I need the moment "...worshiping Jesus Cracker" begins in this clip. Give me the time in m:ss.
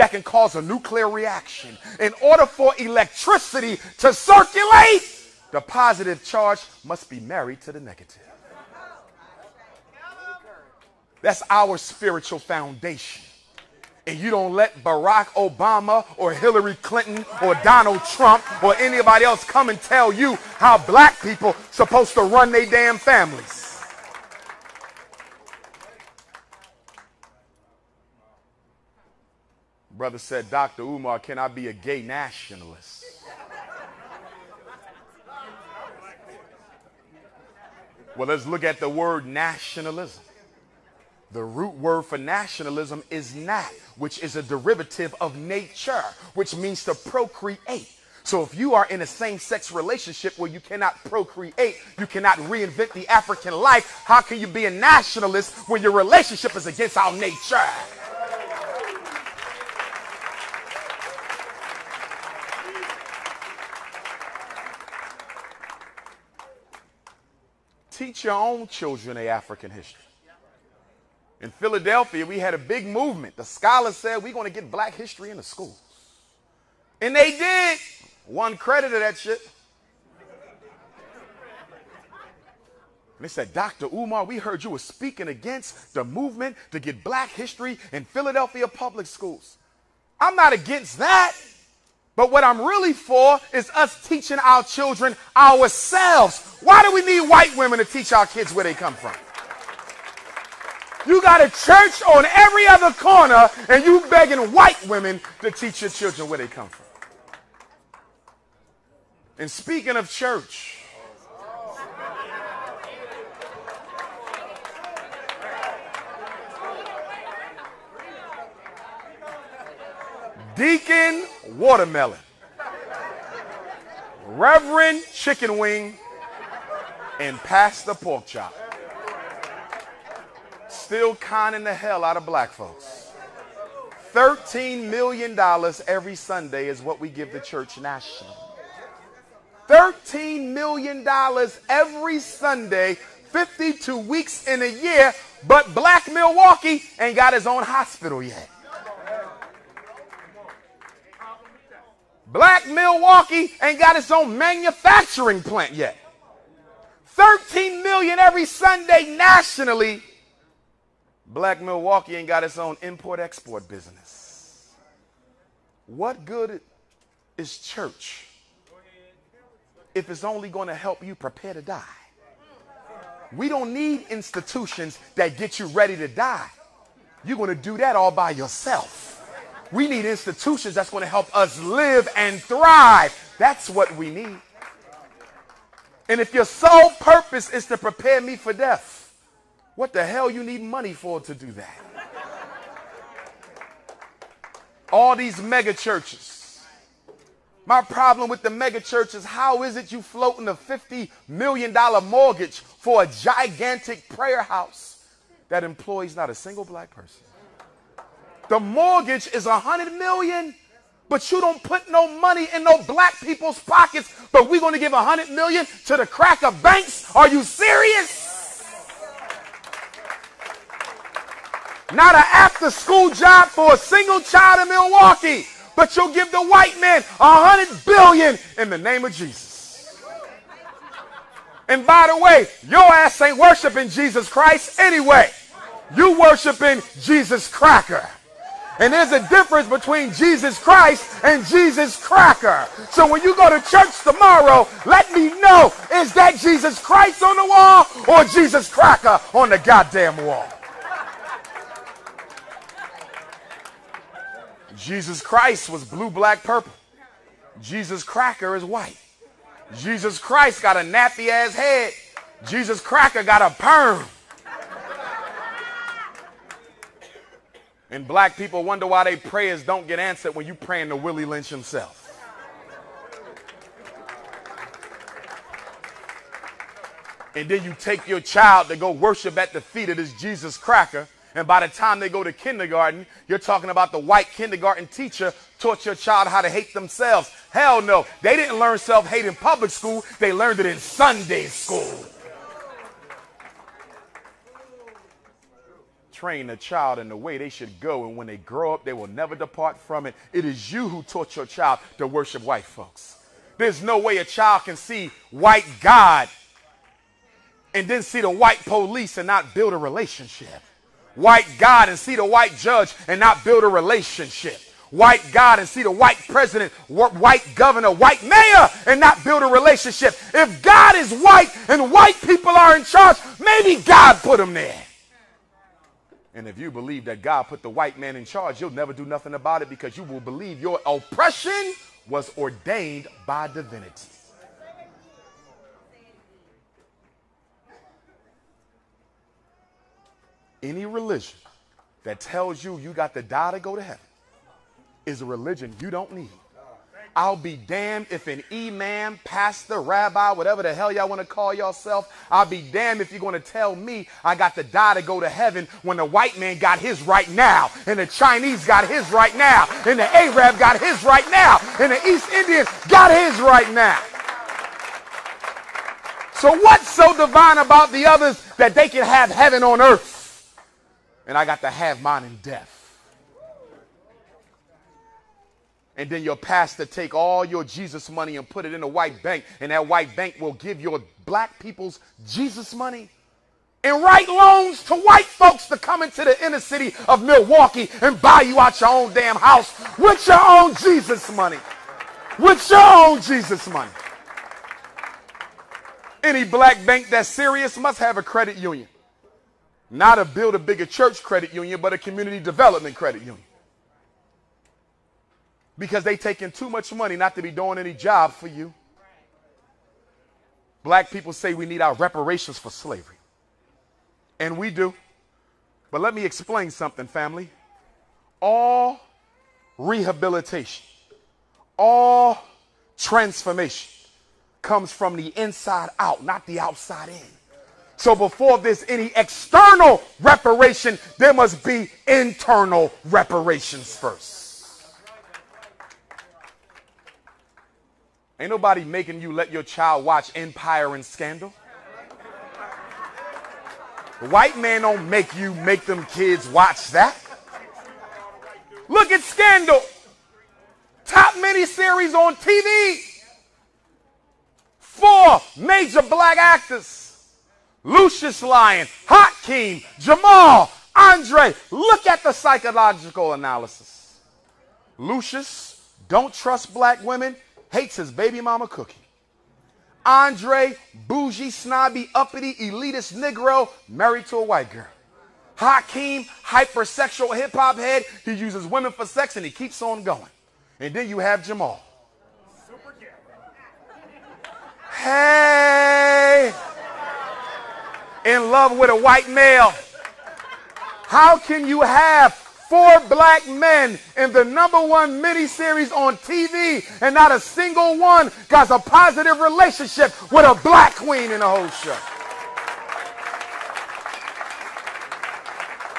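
3:56.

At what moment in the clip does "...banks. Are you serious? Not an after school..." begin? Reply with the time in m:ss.
3:36.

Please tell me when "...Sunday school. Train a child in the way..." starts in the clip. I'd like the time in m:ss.
4:50.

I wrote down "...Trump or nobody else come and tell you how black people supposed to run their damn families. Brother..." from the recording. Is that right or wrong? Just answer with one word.
wrong.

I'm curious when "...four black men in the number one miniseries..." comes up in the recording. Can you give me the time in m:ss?
8:12.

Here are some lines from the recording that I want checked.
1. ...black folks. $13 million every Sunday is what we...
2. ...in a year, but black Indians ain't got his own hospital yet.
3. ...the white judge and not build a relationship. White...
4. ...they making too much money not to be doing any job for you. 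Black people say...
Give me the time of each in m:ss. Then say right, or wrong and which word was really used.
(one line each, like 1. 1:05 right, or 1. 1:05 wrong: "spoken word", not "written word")
1. 2:12 right
2. 2:24 wrong: "Milwaukee", not "Indians"
3. 5:12 right
4. 6:46 wrong: "taking", not "making".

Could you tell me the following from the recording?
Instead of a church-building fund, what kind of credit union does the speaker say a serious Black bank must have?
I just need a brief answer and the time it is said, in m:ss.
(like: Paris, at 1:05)
Community development credit union, at 6:41.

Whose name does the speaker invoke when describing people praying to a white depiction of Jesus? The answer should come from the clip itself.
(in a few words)
Willie Lynch.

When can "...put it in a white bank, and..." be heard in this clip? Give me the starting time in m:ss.
6:18.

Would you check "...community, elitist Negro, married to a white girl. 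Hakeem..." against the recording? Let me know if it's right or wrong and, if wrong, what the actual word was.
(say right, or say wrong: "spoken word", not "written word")
wrong: "uppity", not "community".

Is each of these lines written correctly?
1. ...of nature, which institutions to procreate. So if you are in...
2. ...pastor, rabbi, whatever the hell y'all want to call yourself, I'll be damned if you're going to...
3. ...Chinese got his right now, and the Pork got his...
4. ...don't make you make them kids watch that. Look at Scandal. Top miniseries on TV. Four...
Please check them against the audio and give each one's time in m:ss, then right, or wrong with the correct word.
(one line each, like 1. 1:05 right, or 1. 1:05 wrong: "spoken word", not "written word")
1. 0:45 wrong: "means", not "institutions"
2. 5:49 right
3. 5:58 wrong: "Arab", not "Pork"
4. 7:24 right.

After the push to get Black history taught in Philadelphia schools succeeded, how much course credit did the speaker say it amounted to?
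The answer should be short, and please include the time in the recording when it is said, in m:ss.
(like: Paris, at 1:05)
One credit, at 1:18.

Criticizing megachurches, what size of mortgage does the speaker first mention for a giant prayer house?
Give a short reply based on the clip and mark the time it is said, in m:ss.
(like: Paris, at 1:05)
$50 million, at 3:20.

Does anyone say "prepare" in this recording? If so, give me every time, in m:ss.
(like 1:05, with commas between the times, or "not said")
2:51, 3:07.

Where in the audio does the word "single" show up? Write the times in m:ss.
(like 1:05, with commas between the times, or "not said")
3:26, 3:43, 8:17.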